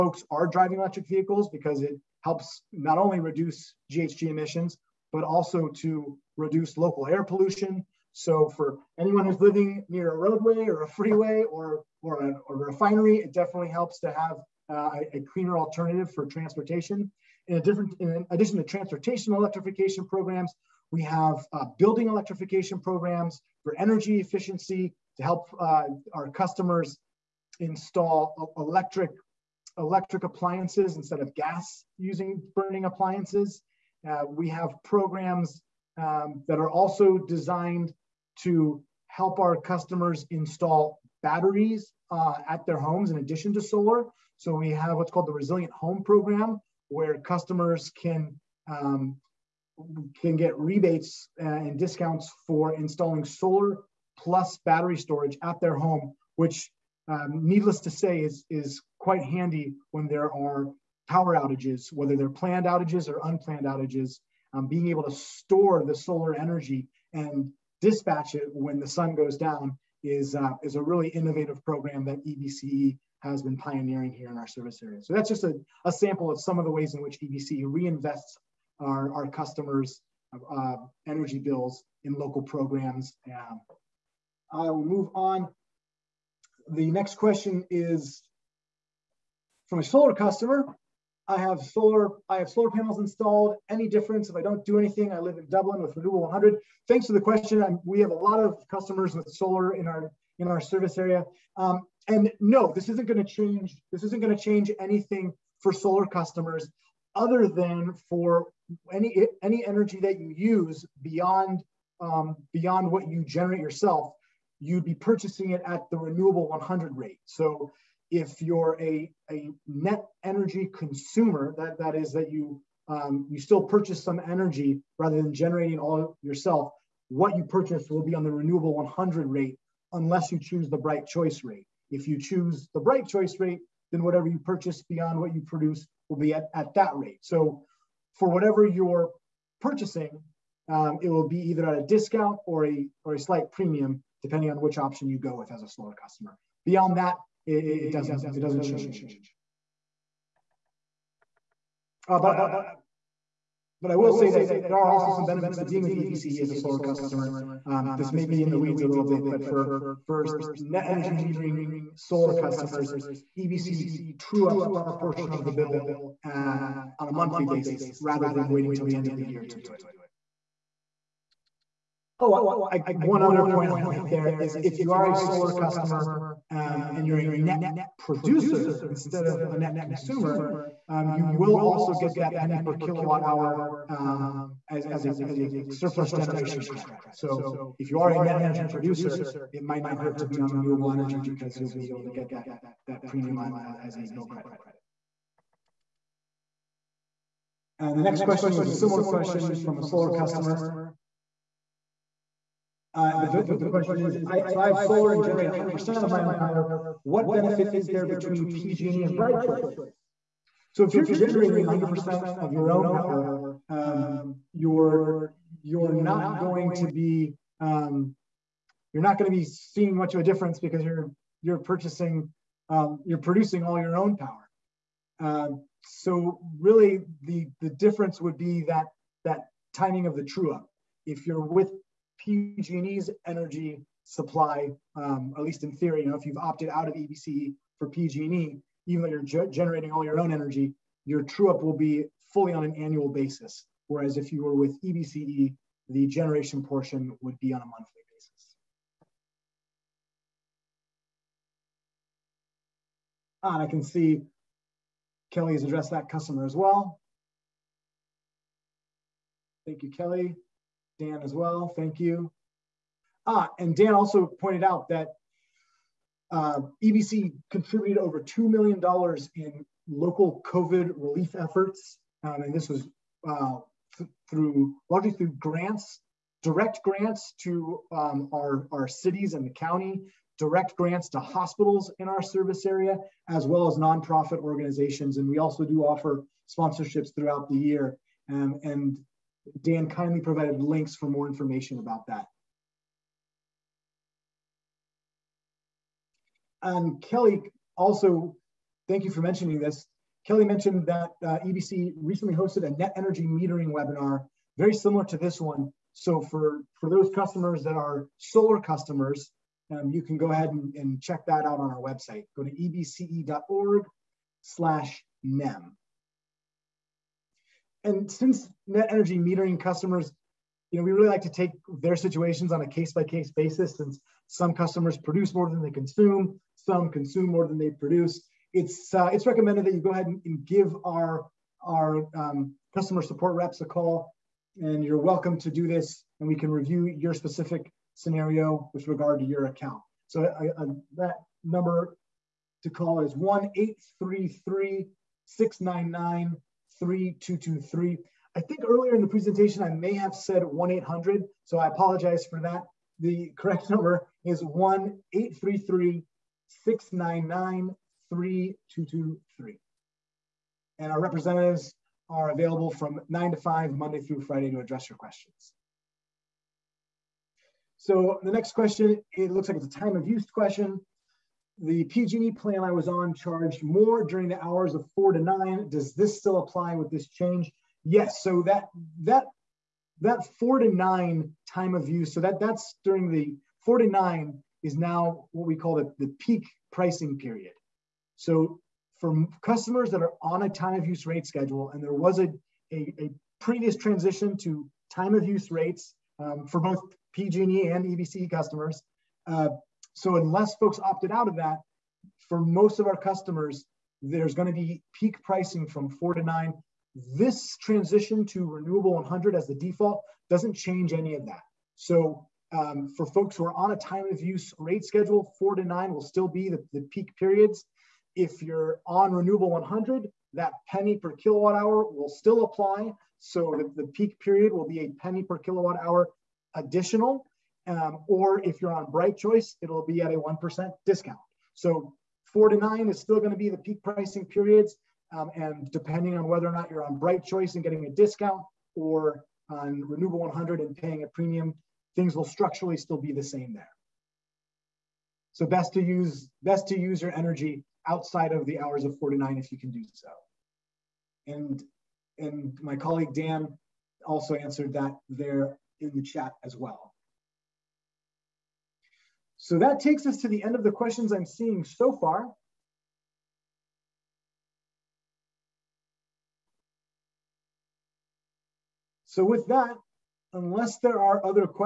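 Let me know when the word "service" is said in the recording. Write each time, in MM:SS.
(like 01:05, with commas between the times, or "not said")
01:14, 01:40, 04:42.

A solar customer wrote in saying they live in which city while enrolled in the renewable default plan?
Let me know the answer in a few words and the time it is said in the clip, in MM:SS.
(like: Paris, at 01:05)
Dublin, at 01:35.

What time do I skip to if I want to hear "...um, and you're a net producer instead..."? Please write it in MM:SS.
02:56.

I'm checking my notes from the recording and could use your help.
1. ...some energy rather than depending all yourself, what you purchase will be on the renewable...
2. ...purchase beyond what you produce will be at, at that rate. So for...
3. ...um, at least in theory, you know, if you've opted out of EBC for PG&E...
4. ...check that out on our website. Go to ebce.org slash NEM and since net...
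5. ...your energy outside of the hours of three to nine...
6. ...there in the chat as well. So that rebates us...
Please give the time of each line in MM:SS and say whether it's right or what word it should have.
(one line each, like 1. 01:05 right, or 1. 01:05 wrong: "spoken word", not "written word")
1. 02:04 wrong: "generating", not "depending"
2. 02:14 right
3. 03:54 right
4. 05:11 right
5. 07:27 wrong: "four", not "three"
6. 07:35 wrong: "takes", not "rebates".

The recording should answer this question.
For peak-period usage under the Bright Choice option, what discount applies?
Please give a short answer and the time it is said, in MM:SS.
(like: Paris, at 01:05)
1%, at 07:10.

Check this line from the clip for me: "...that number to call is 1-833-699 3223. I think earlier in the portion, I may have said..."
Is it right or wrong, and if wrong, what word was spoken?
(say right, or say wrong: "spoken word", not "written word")
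wrong: "presentation", not "portion".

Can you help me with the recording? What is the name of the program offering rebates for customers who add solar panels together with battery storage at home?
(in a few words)
Resilient Home Program.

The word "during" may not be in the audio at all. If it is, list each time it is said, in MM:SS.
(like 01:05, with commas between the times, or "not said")
06:14, 06:22.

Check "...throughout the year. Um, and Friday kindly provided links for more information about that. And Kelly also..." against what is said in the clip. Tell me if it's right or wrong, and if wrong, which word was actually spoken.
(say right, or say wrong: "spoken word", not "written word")
wrong: "Dan", not "Friday".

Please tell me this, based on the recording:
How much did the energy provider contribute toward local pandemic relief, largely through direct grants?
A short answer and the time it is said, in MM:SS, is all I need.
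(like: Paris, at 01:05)
Over $2 million, at 04:27.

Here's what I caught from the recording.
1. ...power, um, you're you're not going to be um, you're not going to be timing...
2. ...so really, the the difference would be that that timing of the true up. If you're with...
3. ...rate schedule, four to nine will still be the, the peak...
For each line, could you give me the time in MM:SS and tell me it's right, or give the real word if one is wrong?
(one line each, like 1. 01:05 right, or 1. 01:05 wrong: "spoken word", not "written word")
1. 03:32 wrong: "seeing", not "timing"
2. 03:45 right
3. 06:54 right.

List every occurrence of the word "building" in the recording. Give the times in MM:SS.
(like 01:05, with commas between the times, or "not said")
00:21.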